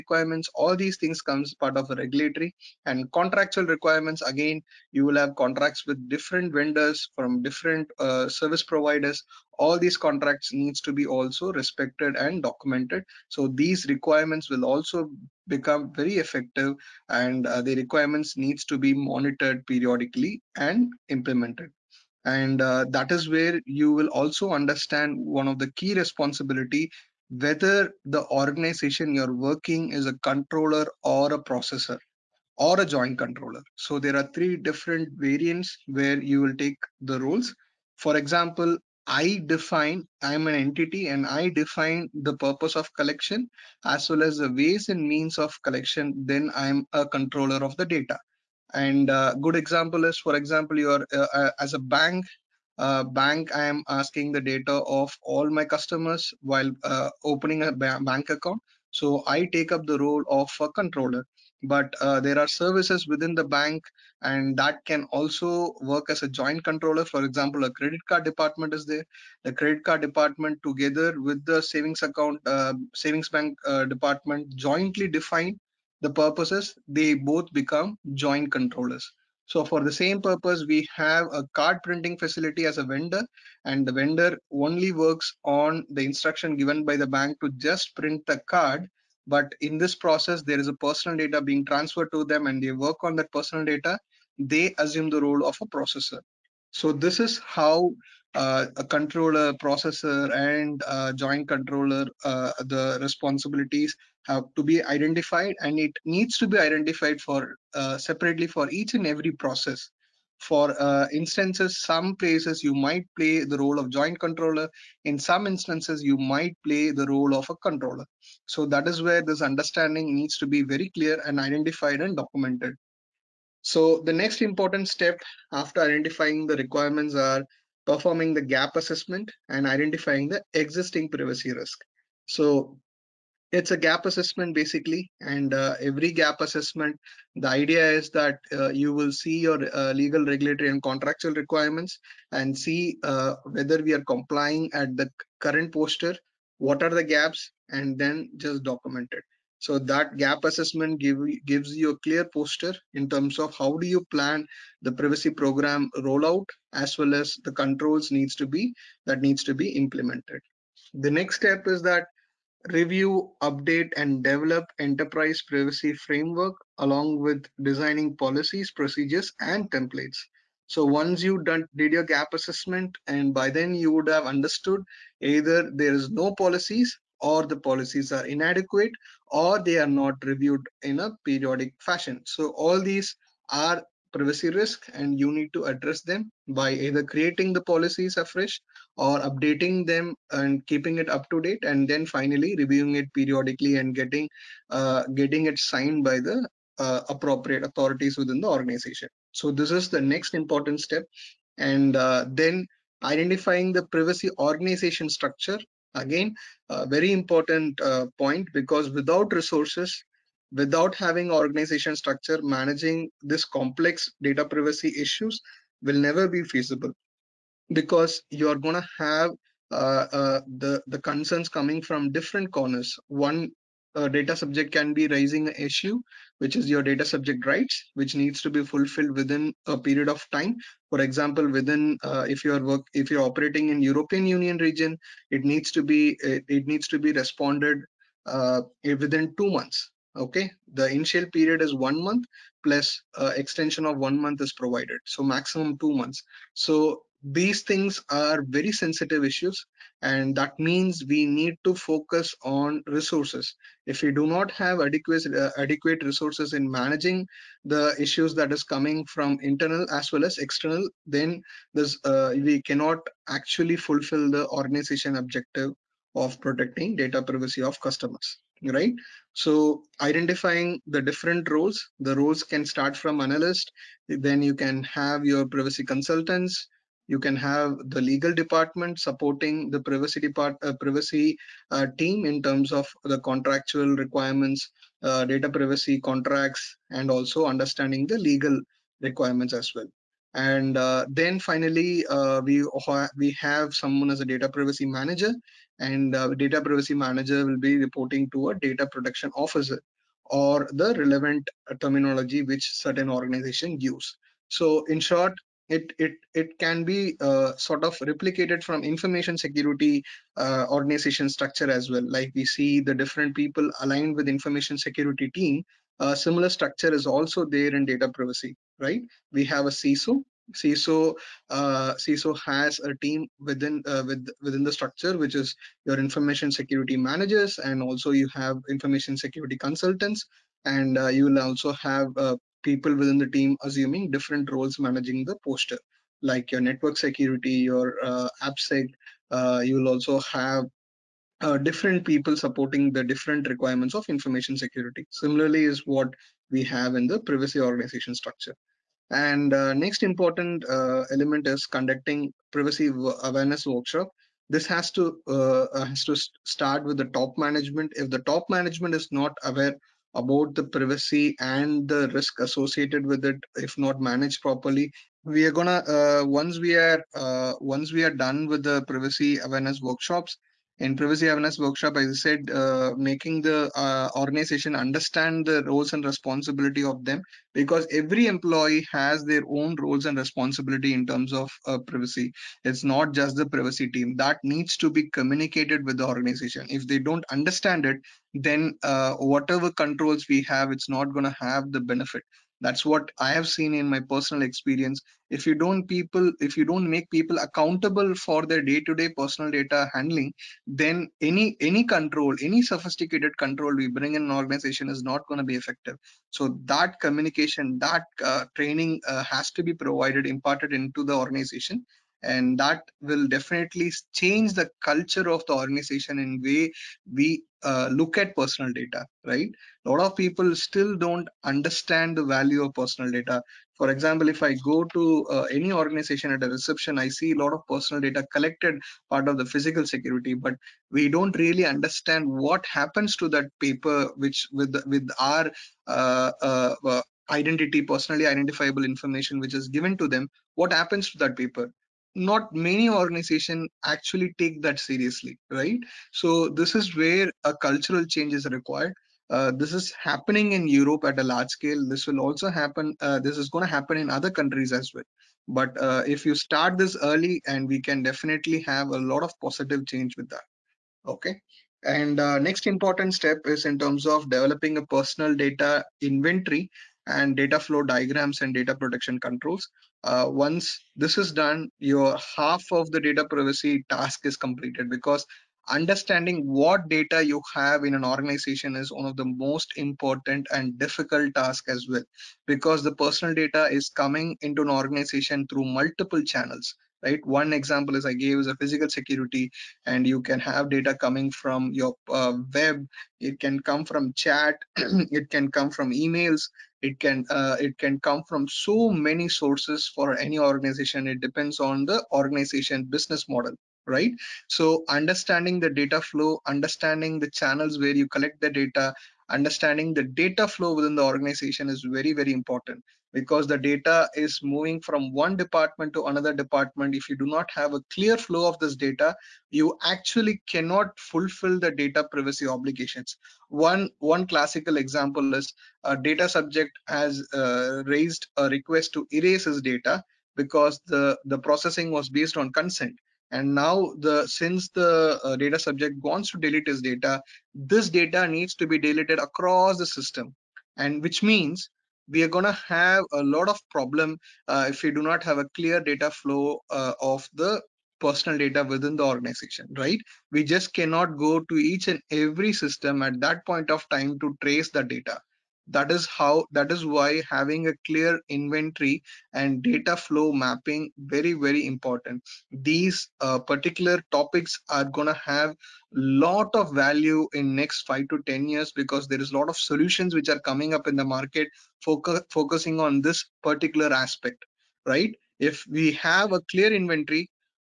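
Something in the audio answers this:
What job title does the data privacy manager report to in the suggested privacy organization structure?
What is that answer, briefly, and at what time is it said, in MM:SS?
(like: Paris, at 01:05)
data protection officer, at 04:58.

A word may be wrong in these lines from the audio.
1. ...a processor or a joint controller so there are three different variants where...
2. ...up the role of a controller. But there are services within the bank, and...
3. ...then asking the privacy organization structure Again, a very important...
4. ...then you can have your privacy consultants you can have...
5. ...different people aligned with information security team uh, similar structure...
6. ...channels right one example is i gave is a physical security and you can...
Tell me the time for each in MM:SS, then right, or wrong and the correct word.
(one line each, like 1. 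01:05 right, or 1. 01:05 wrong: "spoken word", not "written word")
1. 00:31 right
2. 00:59 right
3. 03:22 wrong: "identifying", not "asking"
4. 04:34 right
5. 05:13 right
6. 08:06 right.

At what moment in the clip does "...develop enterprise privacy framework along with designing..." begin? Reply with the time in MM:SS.
02:44.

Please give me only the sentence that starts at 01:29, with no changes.
But in this process, there is a personal data being transferred to them, and they work on that personal data.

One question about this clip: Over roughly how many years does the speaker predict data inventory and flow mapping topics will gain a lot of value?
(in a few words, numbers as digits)
5 to 10 years.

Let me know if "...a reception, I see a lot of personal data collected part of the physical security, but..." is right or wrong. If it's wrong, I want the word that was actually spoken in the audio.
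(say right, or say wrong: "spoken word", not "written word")
right.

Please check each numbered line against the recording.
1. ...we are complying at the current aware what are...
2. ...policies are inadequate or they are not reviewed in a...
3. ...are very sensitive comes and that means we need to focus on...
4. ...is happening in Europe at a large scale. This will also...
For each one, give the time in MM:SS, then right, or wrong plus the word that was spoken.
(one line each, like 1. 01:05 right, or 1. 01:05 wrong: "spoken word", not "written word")
1. 02:23 wrong: "posture", not "aware"
2. 02:57 right
3. 04:08 wrong: "issues", not "comes"
4. 07:29 right.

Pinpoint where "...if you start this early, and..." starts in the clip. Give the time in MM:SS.
07:36.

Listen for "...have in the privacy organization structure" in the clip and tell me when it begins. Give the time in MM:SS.
05:46.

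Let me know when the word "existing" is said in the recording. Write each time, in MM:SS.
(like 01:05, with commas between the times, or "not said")
02:10.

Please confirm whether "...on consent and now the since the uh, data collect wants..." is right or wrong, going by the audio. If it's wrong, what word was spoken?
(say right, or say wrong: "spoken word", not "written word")
wrong: "subject", not "collect".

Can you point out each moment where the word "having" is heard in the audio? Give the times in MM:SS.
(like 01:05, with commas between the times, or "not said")
03:30, 09:17.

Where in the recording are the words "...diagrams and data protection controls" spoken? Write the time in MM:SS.
07:47.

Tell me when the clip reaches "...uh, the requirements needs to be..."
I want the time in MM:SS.
00:17.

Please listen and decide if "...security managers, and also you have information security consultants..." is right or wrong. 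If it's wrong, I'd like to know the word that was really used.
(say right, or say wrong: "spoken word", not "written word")
right.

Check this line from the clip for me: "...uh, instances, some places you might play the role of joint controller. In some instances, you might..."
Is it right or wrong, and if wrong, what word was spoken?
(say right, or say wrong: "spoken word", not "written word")
right.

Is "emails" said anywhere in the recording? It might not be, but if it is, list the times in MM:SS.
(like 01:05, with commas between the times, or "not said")
08:15.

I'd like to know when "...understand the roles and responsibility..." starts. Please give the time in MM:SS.
06:14.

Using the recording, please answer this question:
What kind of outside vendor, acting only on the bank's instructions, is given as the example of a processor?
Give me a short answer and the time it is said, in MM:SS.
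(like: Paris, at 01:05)
card printing facility, at 01:21.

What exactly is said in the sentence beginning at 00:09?
All these contracts needs to be also respected and documented.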